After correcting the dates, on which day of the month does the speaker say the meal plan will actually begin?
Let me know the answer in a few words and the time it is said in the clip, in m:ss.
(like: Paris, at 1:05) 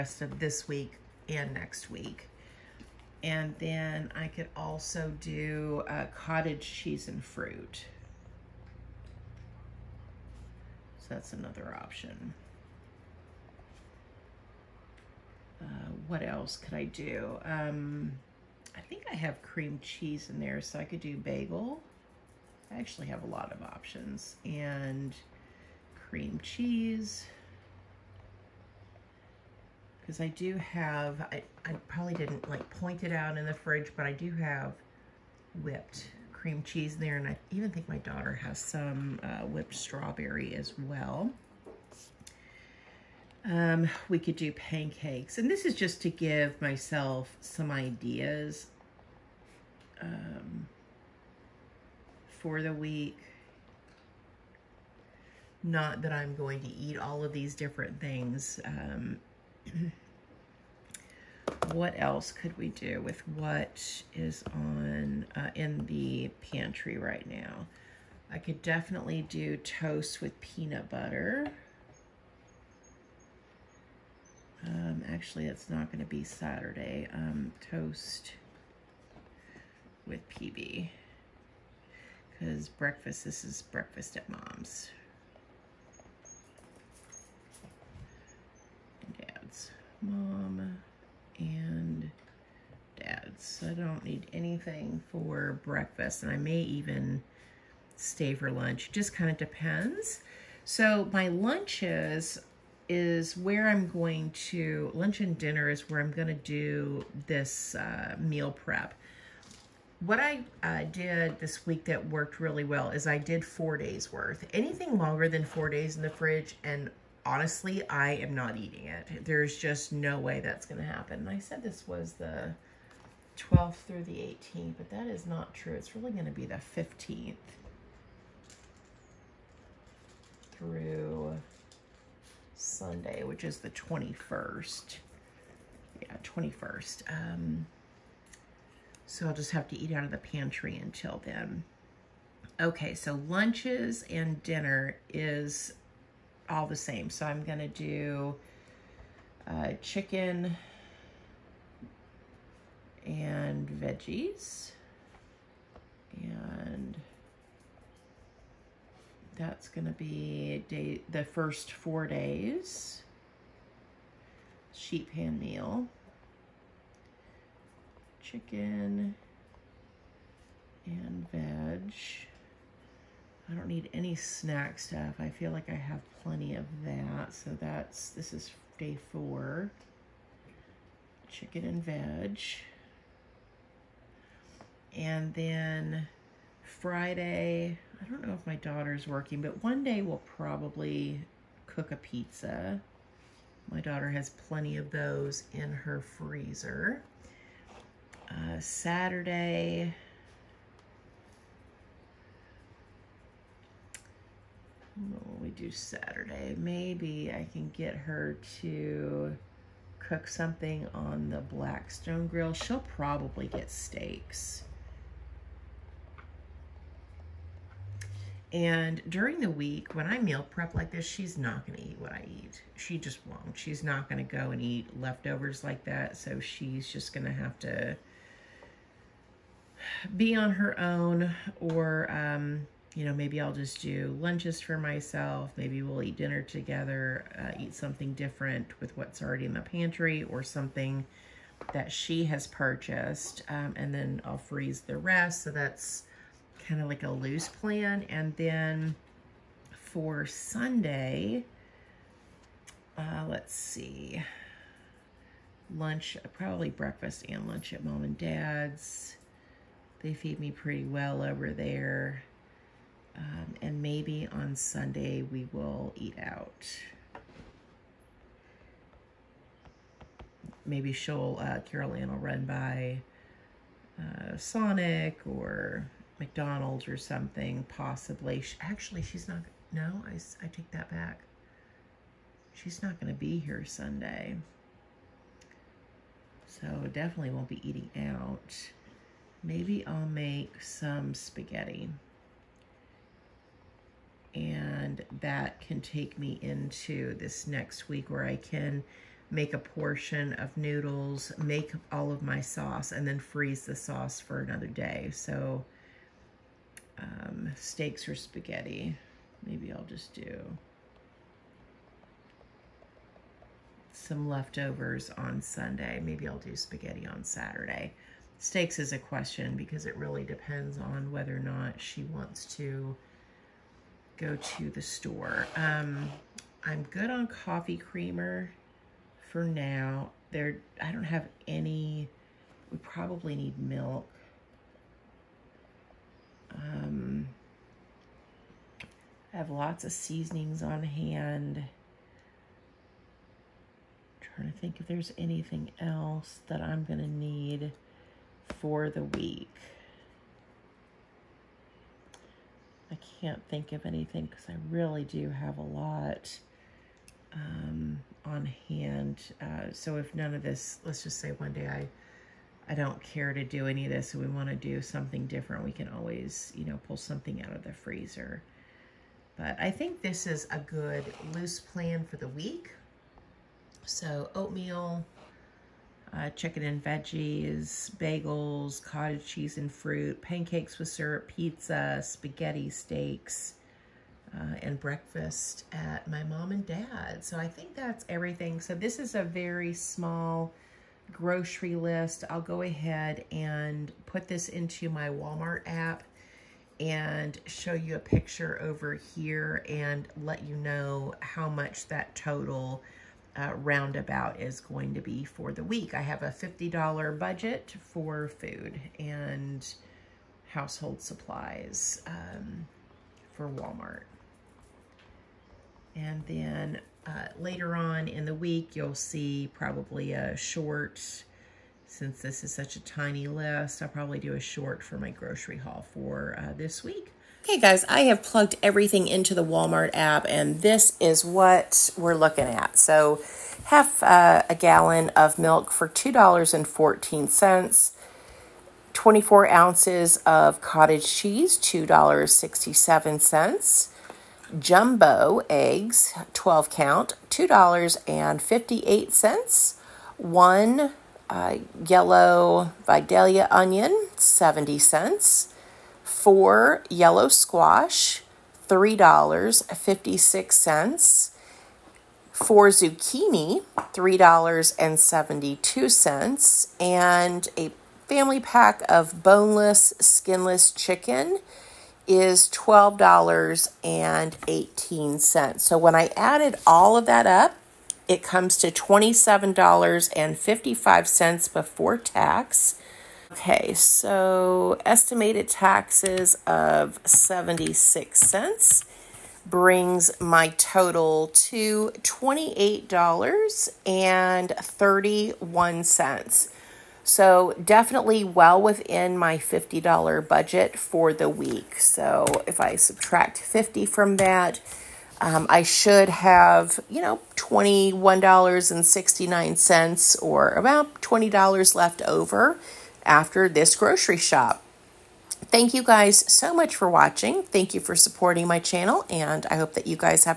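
15th, at 2:06.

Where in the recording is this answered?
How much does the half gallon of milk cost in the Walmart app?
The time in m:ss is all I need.
7:15.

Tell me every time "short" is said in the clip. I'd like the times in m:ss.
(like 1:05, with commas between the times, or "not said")
7:00, 7:04.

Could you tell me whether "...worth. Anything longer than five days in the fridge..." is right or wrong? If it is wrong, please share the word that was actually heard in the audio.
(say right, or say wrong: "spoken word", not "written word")
wrong: "four", not "five".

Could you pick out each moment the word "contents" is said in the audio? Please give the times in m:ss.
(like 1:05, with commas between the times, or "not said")
not said.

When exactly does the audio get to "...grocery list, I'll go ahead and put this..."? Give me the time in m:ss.
6:31.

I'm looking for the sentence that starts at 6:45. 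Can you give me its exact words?
I have a $50 budget for food and household supplies um, for Walmart.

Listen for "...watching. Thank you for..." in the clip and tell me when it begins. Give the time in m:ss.
8:36.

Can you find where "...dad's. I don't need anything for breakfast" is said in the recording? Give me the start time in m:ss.
1:32.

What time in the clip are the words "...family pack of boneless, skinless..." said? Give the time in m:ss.
7:48.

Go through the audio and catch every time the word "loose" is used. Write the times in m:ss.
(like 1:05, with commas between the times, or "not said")
4:07, 6:11.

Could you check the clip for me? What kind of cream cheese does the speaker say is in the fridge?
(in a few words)
Whipped cream cheese.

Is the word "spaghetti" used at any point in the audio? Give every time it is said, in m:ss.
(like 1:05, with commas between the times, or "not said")
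4:51, 5:08, 5:16, 6:22.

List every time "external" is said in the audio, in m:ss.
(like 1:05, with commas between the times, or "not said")
not said.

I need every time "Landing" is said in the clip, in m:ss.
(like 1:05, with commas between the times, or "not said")
not said.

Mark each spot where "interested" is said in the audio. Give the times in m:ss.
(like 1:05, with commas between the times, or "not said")
not said.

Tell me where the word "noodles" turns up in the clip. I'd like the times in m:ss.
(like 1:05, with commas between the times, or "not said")
5:00.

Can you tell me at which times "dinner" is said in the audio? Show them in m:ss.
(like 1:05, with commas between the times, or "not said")
1:45, 2:24, 3:56.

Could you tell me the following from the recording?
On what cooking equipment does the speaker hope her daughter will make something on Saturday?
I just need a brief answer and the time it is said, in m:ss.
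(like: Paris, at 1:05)
Blackstone Grill, at 3:31.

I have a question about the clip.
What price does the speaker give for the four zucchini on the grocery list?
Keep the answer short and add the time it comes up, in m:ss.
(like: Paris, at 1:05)
$3.72, at 7:43.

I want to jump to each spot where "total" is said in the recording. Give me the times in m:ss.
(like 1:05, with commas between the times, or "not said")
6:42.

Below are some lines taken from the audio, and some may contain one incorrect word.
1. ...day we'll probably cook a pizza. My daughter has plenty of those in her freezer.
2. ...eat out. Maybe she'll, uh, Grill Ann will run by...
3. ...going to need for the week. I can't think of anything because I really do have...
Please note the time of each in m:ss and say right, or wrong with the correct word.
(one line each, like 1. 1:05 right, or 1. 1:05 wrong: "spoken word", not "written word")
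1. 3:09 right
2. 4:25 wrong: "Carol", not "Grill"
3. 5:46 right.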